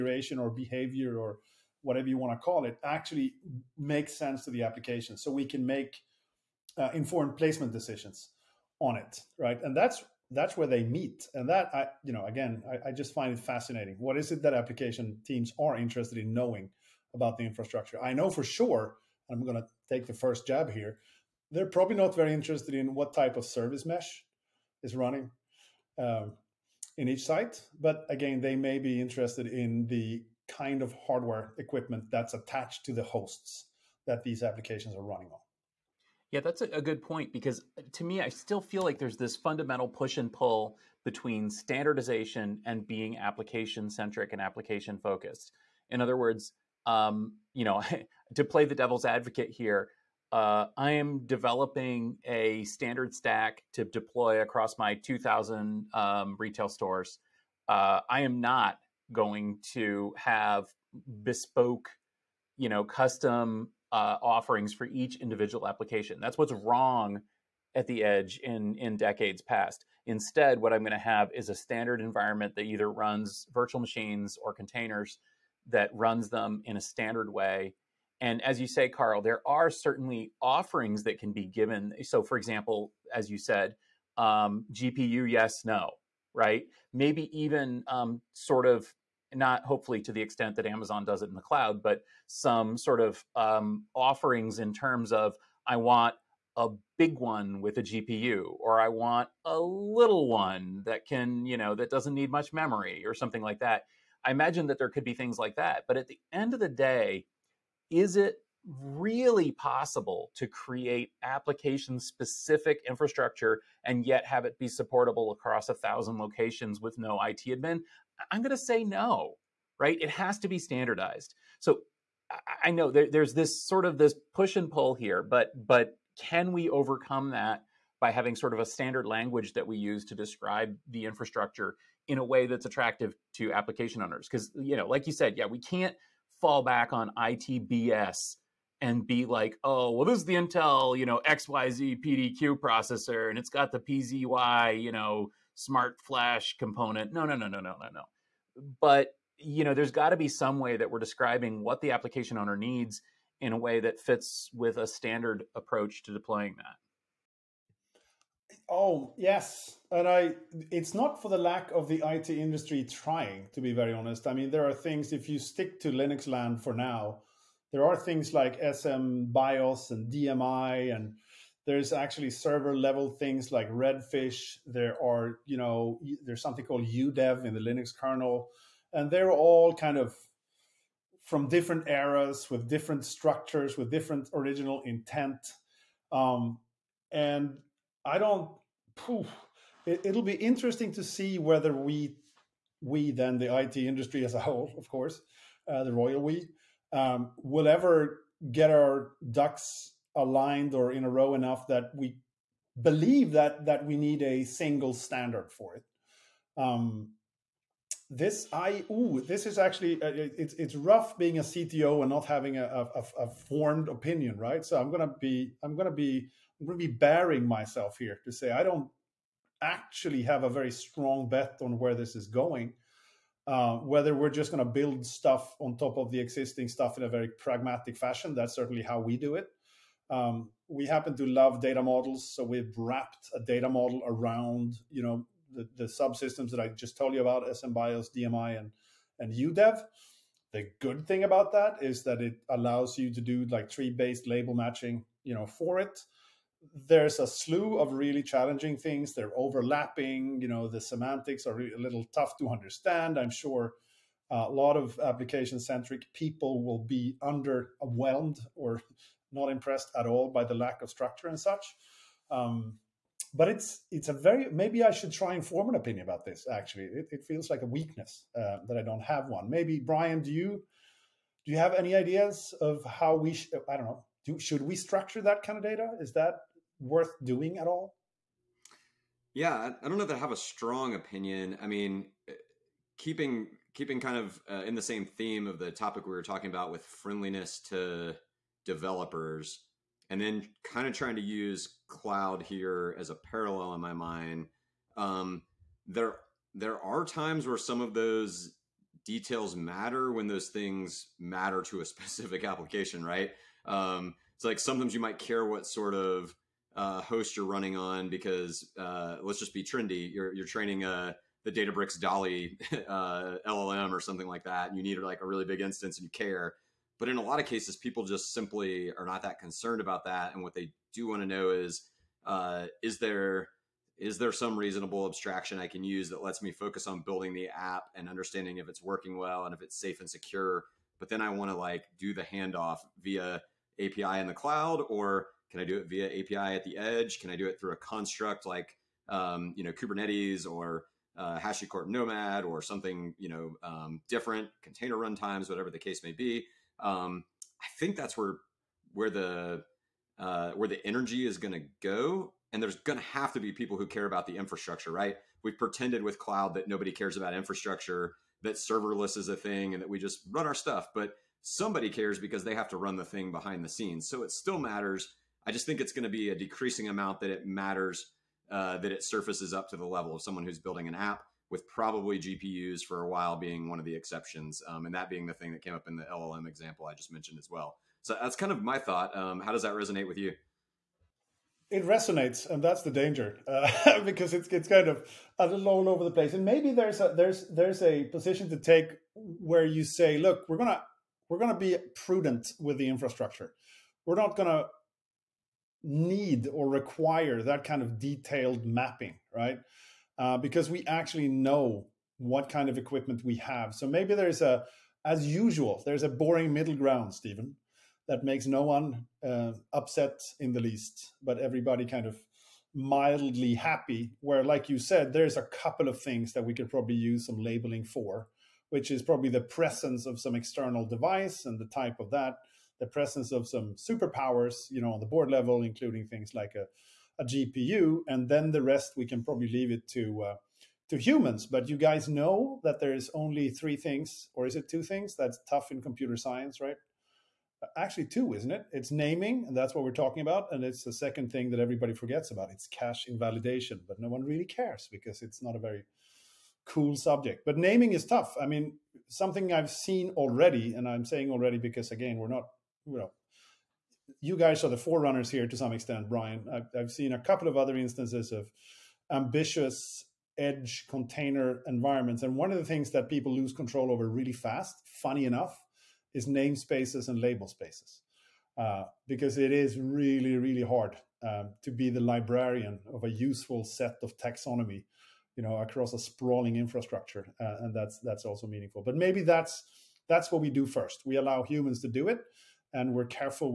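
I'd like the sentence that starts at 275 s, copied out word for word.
Is that worth doing at all?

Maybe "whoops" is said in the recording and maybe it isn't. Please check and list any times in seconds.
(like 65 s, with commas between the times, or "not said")
not said.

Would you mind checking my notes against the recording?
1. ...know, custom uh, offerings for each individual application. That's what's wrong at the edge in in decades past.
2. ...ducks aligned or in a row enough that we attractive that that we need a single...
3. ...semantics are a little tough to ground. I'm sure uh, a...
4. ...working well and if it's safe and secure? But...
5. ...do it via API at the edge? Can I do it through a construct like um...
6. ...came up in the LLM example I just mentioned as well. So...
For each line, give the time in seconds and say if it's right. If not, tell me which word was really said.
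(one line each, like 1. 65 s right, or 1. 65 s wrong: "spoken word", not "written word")
1. 62 s right
2. 199 s wrong: "believe", not "attractive"
3. 250 s wrong: "understand", not "ground"
4. 328 s right
5. 335 s right
6. 375 s right.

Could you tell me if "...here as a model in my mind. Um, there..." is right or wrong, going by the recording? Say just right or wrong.
wrong.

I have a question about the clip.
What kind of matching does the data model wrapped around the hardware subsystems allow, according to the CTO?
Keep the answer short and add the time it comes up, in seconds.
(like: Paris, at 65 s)
Tree-based label matching, at 243 s.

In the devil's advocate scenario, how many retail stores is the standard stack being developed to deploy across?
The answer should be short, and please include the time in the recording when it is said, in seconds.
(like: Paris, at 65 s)
2,000, at 54 s.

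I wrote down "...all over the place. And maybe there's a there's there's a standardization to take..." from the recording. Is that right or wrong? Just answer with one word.
wrong.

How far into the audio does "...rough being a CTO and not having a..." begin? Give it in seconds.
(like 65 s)
210 s.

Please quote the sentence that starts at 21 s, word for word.
They're probably not very interested in what type of service mesh is running um, in each site.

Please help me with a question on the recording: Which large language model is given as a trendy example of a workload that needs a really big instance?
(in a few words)
Databricks Dolly.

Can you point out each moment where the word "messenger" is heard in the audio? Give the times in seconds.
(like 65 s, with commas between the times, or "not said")
not said.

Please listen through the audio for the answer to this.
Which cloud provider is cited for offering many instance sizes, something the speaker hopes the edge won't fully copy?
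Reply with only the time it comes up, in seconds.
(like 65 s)
90 s.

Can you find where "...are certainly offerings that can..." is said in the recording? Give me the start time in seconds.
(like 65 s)
79 s.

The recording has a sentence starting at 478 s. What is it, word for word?
But maybe that's that's what we do first.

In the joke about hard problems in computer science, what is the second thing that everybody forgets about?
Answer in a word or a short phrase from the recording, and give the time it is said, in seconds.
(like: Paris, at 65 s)
Cache invalidation, at 442 s.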